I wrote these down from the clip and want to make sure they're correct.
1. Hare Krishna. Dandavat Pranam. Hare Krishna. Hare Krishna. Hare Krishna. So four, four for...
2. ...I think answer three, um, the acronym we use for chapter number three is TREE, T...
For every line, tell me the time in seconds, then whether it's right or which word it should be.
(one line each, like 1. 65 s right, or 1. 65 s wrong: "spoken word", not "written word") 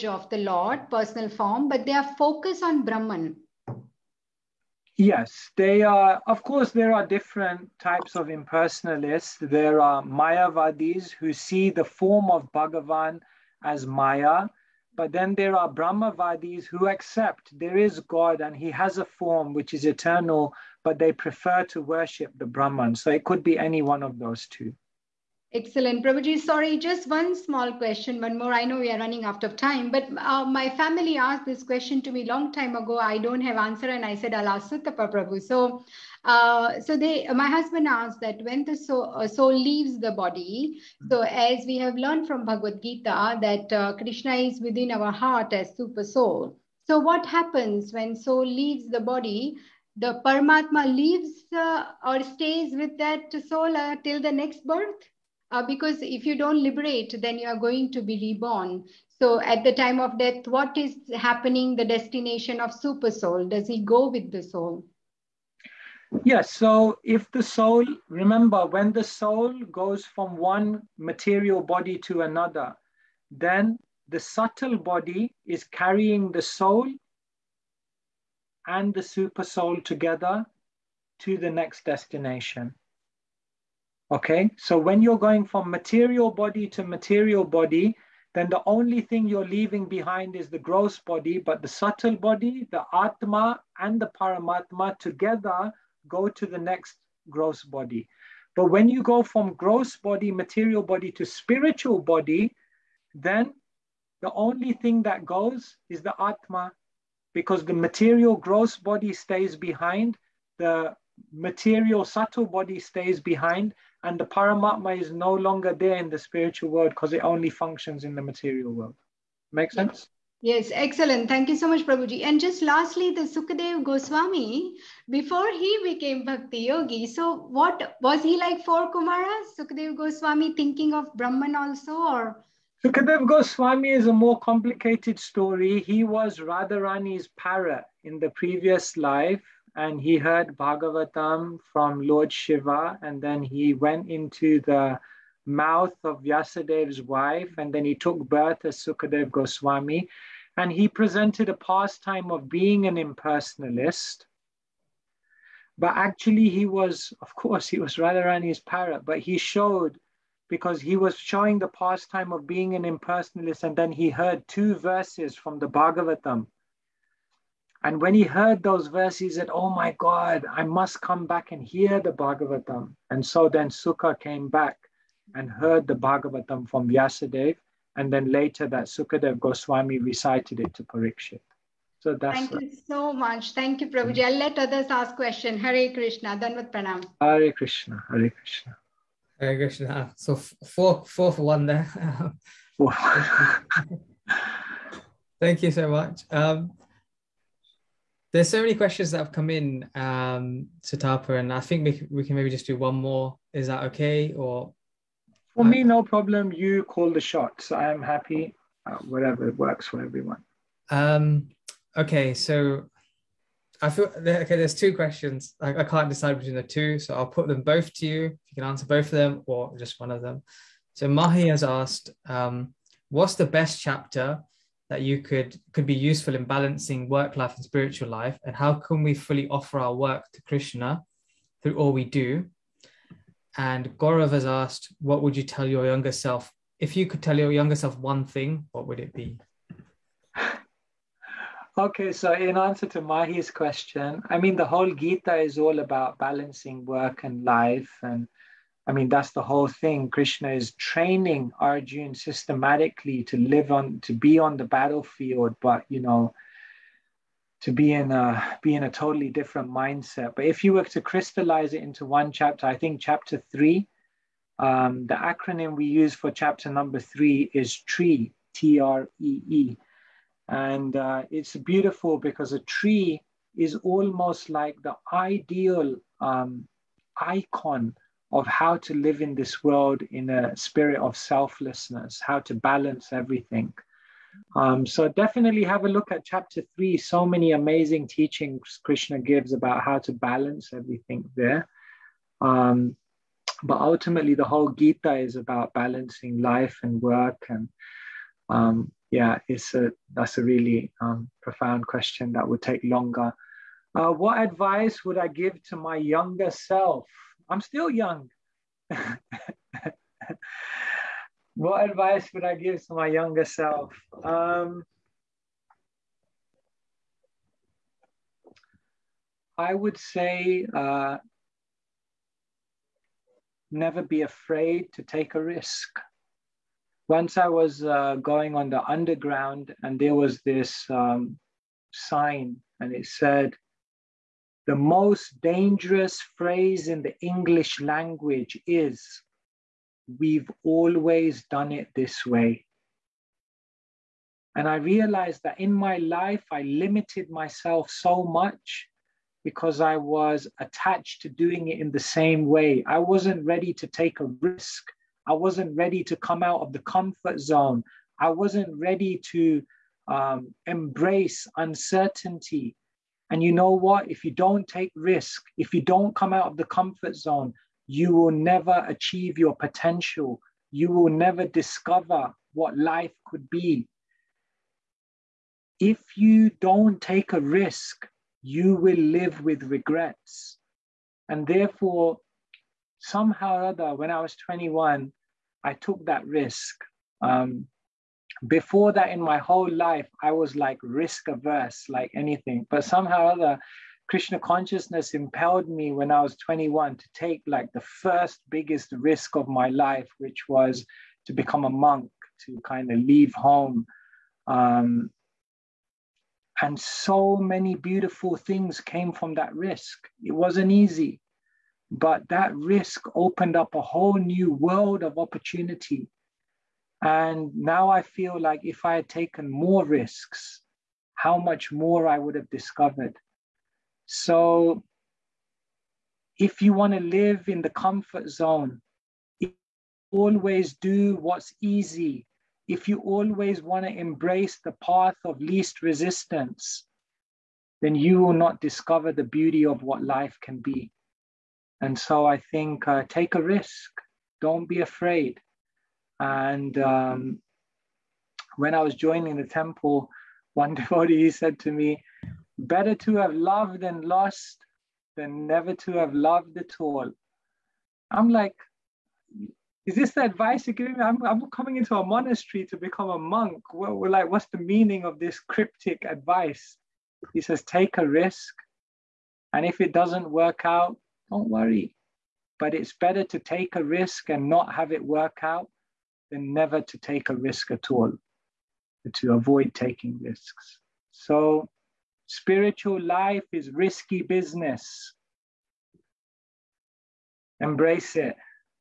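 1. 185 s right
2. 262 s wrong: "chapter", not "answer".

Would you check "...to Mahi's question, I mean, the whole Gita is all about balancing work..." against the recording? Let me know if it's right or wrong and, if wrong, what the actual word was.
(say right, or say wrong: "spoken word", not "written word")
right.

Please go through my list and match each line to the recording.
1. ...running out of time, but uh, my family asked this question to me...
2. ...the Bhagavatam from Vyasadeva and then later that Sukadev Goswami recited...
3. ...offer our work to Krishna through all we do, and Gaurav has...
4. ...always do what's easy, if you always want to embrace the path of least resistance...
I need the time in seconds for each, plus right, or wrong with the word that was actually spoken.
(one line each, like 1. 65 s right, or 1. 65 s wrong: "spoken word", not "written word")
1. 28 s right
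2. 175 s right
3. 229 s right
4. 430 s right.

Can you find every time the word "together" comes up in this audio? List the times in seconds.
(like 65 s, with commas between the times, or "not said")
79 s, 94 s.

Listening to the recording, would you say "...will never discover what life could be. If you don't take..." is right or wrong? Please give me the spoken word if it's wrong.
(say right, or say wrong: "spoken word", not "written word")
right.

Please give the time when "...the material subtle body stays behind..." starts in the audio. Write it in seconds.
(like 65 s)
110 s.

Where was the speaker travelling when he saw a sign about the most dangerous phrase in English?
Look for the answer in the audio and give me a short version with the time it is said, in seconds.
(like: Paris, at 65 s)
the underground, at 328 s.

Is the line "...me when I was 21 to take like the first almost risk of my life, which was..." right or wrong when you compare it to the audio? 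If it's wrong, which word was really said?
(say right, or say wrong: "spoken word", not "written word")
wrong: "biggest", not "almost".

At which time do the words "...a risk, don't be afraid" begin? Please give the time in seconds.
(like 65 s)
443 s.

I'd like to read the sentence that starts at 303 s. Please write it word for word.
Uh, what advice would I give to my younger self?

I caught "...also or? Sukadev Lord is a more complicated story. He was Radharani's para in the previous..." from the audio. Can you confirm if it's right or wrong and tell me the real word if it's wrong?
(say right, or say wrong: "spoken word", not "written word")
wrong: "Goswami", not "Lord".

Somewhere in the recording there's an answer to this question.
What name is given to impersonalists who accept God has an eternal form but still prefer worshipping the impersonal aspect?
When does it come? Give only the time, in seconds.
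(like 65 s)
15 s.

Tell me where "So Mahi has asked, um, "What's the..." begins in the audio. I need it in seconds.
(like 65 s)
220 s.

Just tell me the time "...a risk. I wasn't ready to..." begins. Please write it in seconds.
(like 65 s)
354 s.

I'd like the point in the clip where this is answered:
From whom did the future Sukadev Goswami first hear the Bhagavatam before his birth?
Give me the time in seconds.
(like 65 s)
142 s.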